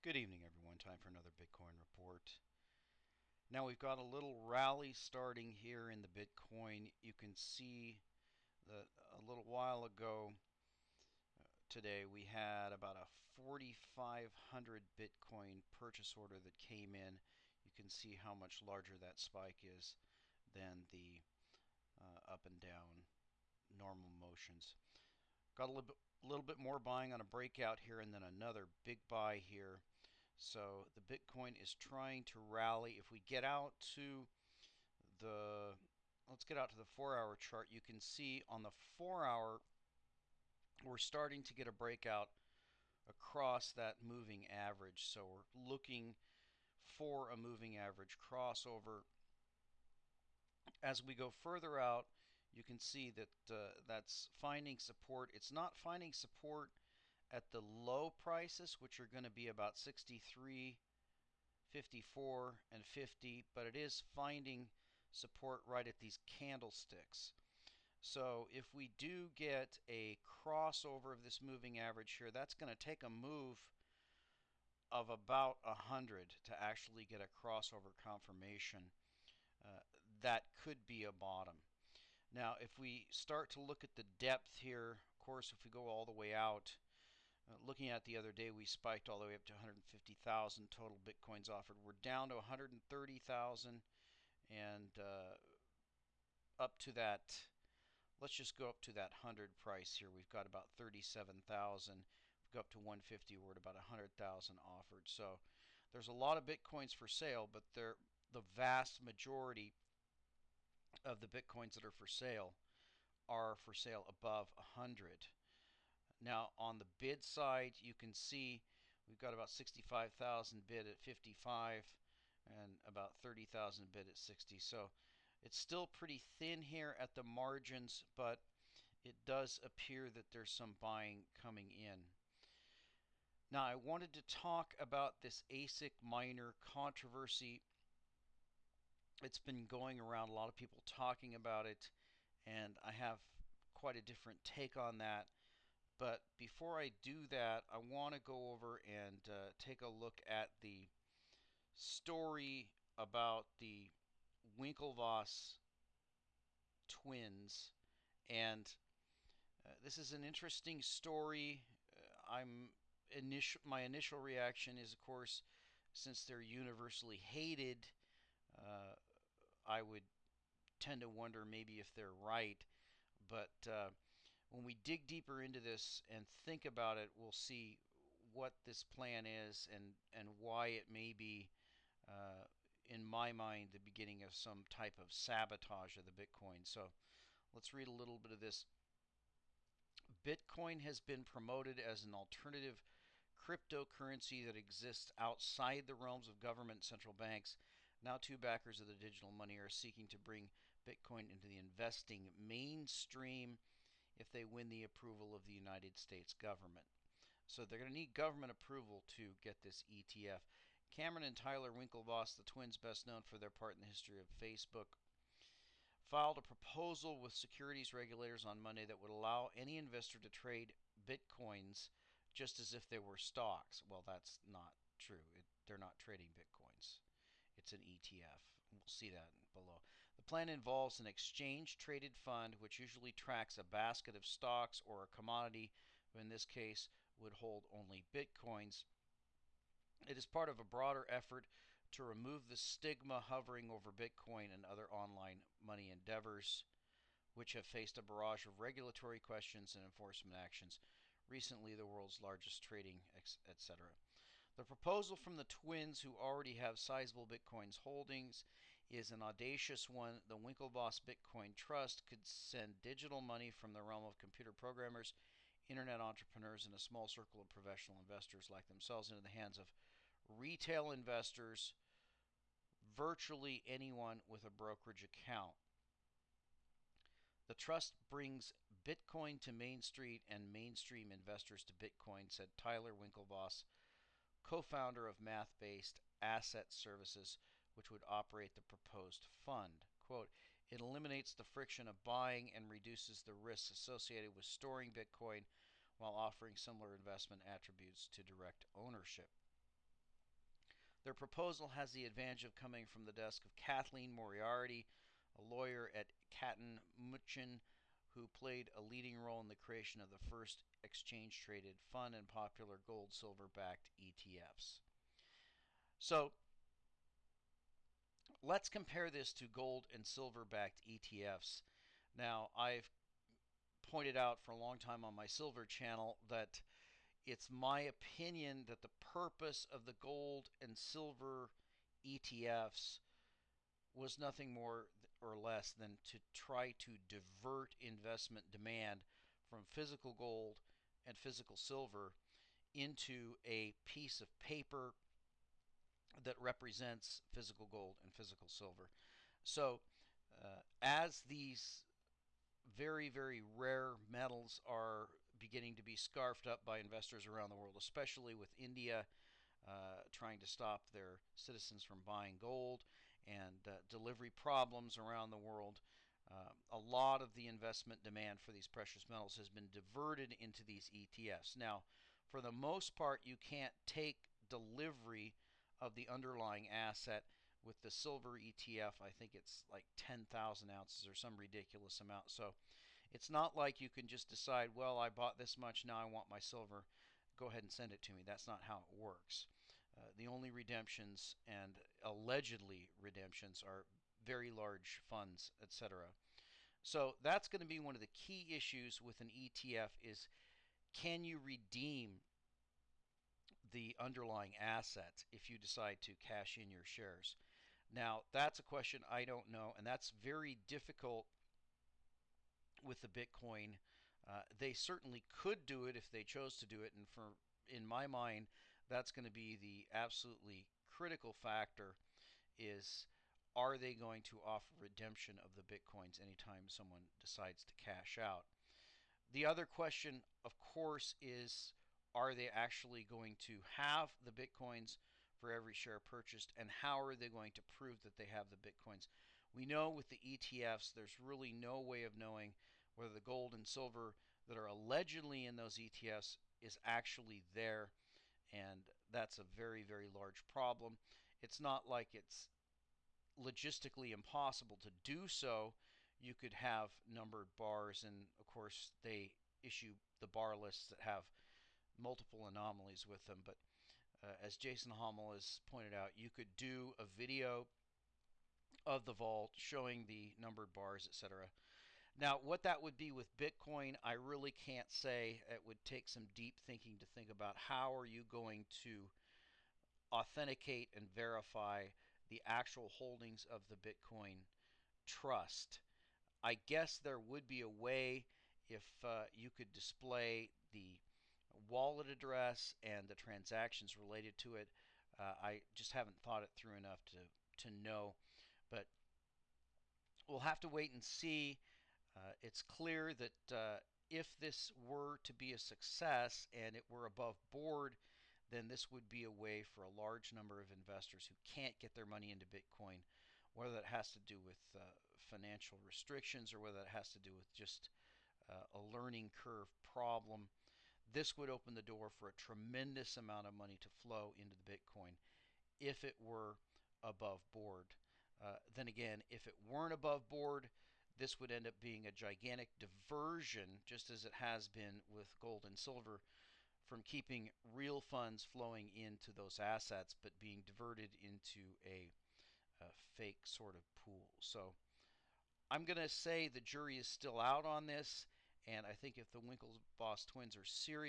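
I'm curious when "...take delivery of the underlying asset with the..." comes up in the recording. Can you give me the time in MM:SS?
06:13.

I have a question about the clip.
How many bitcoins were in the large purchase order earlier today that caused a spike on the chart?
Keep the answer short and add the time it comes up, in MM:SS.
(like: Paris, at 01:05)
4,500, at 00:13.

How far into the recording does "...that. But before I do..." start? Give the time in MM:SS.
02:24.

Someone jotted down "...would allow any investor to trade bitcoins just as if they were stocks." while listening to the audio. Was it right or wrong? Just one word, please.
right.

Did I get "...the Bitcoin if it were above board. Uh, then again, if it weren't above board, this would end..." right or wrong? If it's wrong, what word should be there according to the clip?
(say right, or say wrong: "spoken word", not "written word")
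right.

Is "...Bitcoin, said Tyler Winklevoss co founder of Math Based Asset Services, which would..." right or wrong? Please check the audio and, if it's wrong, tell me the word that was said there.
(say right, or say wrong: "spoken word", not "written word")
right.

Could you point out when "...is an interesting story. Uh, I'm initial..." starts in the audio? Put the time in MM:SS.
02:39.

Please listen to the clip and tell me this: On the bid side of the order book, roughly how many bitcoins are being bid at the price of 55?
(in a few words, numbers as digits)
65,000.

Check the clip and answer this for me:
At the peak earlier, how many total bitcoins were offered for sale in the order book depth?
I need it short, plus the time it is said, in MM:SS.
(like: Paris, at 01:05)
150,000, at 01:29.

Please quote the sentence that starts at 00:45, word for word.
So we're looking for a moving average crossover.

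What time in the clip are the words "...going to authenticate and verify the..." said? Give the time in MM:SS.
07:58.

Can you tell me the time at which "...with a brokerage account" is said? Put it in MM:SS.
04:34.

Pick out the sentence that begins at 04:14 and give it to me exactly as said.
The proposal from the twins, who already have sizable Bitcoin's holdings, is an audacious one.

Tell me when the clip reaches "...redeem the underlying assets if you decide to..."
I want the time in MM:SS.
06:41.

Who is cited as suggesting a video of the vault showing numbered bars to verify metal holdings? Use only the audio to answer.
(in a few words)
Jason Hommel.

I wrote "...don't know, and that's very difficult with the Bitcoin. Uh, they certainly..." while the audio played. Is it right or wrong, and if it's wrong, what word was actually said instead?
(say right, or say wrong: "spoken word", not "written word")
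right.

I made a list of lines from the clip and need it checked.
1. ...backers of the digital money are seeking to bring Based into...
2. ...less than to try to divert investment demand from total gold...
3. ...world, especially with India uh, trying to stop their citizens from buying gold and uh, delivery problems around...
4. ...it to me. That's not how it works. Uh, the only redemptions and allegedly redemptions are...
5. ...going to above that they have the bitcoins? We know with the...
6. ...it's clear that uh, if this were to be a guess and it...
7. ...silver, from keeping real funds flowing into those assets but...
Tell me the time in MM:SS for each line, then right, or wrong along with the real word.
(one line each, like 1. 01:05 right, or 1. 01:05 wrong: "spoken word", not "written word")
1. 03:18 wrong: "Bitcoin", not "Based"
2. 05:35 wrong: "physical", not "total"
3. 05:57 right
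4. 06:27 right
5. 07:17 wrong: "prove", not "above"
6. 08:22 wrong: "success", not "guess"
7. 08:55 right.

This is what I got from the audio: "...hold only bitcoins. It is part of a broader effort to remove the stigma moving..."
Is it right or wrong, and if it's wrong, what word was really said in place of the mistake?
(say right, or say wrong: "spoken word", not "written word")
wrong: "hovering", not "moving".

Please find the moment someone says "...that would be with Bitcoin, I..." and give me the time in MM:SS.
07:52.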